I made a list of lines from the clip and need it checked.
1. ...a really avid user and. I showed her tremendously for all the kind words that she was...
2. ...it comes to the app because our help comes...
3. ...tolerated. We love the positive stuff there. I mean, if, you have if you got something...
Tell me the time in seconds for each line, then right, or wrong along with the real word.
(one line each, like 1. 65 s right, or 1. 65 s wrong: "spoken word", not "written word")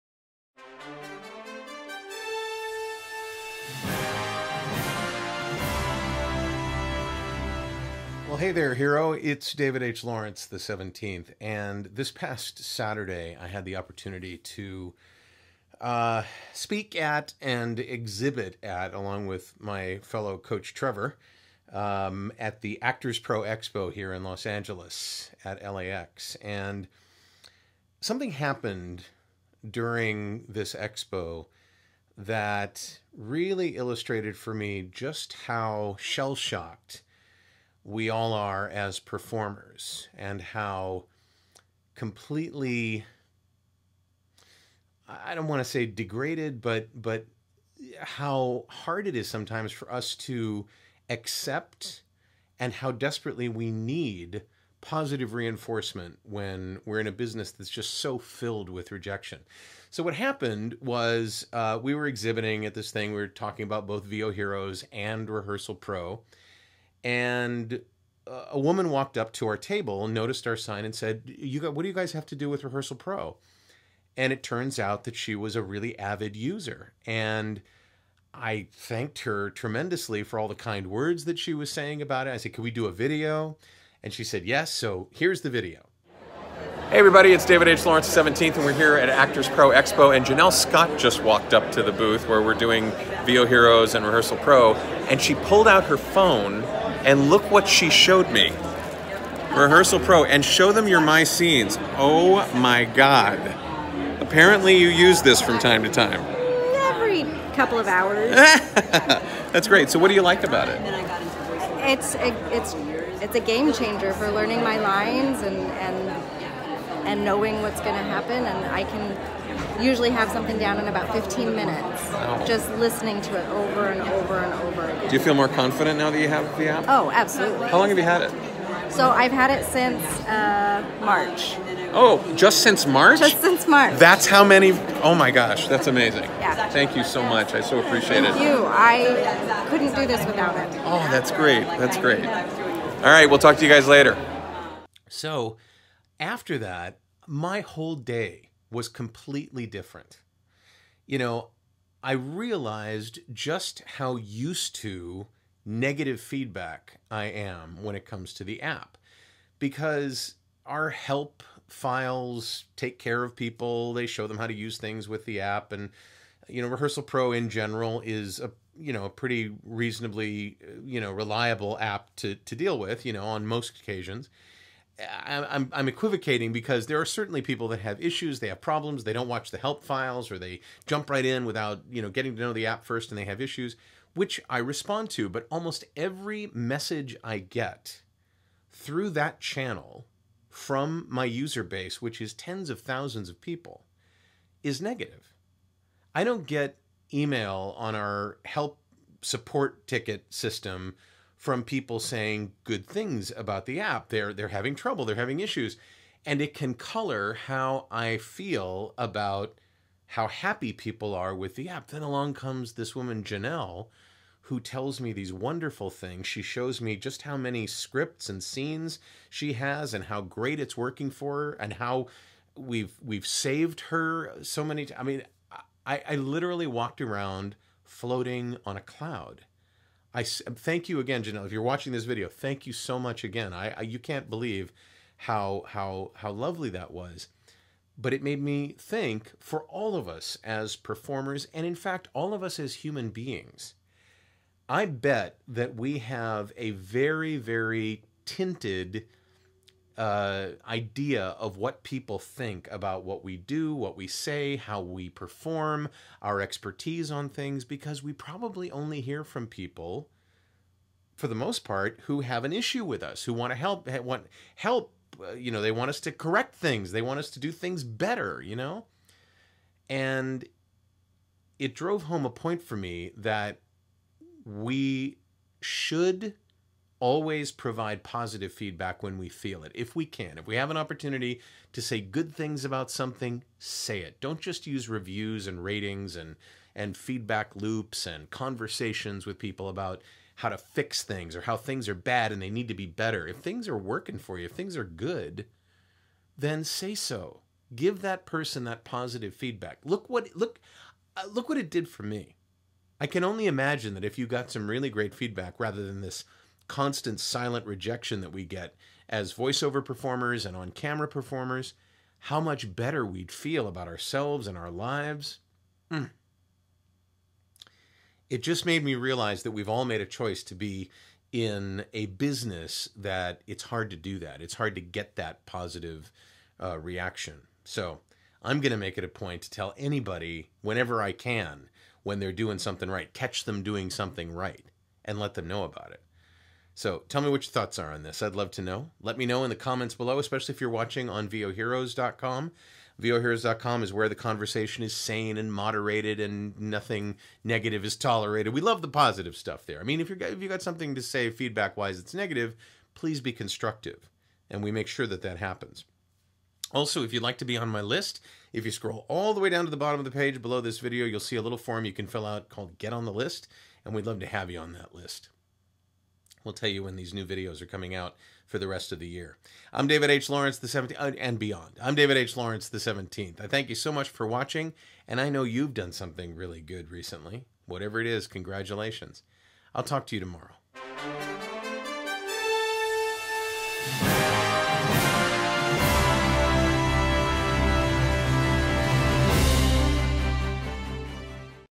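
1. 75 s wrong: "thanked", not "showed"
2. 157 s wrong: "files", not "comes"
3. 347 s right.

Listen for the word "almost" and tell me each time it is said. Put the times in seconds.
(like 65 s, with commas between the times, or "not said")
185 s.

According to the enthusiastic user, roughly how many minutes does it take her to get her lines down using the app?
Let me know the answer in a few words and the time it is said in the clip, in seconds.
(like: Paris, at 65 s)
15, at 121 s.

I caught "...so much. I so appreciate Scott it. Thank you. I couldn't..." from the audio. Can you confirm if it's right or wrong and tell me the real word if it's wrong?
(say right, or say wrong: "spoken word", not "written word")
wrong: "Thank", not "Scott".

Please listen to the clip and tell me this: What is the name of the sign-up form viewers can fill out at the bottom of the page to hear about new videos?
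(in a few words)
Get on the List.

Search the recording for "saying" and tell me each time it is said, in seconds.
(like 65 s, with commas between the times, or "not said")
81 s, 201 s.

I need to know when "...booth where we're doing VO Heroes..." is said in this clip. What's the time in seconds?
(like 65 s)
91 s.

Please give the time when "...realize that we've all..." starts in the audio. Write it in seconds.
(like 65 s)
318 s.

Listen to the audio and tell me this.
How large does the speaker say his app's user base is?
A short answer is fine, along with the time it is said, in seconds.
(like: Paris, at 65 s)
Tens of thousands, at 192 s.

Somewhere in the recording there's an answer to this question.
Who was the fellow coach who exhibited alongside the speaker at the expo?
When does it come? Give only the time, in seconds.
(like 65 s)
20 s.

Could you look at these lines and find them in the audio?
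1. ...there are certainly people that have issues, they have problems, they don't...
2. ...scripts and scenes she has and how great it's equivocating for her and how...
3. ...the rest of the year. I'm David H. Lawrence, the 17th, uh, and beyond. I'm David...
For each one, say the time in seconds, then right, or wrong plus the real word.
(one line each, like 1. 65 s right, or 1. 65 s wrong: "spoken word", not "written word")
1. 176 s right
2. 217 s wrong: "working", not "equivocating"
3. 368 s right.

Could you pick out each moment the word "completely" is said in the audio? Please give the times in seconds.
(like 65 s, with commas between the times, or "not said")
41 s, 148 s.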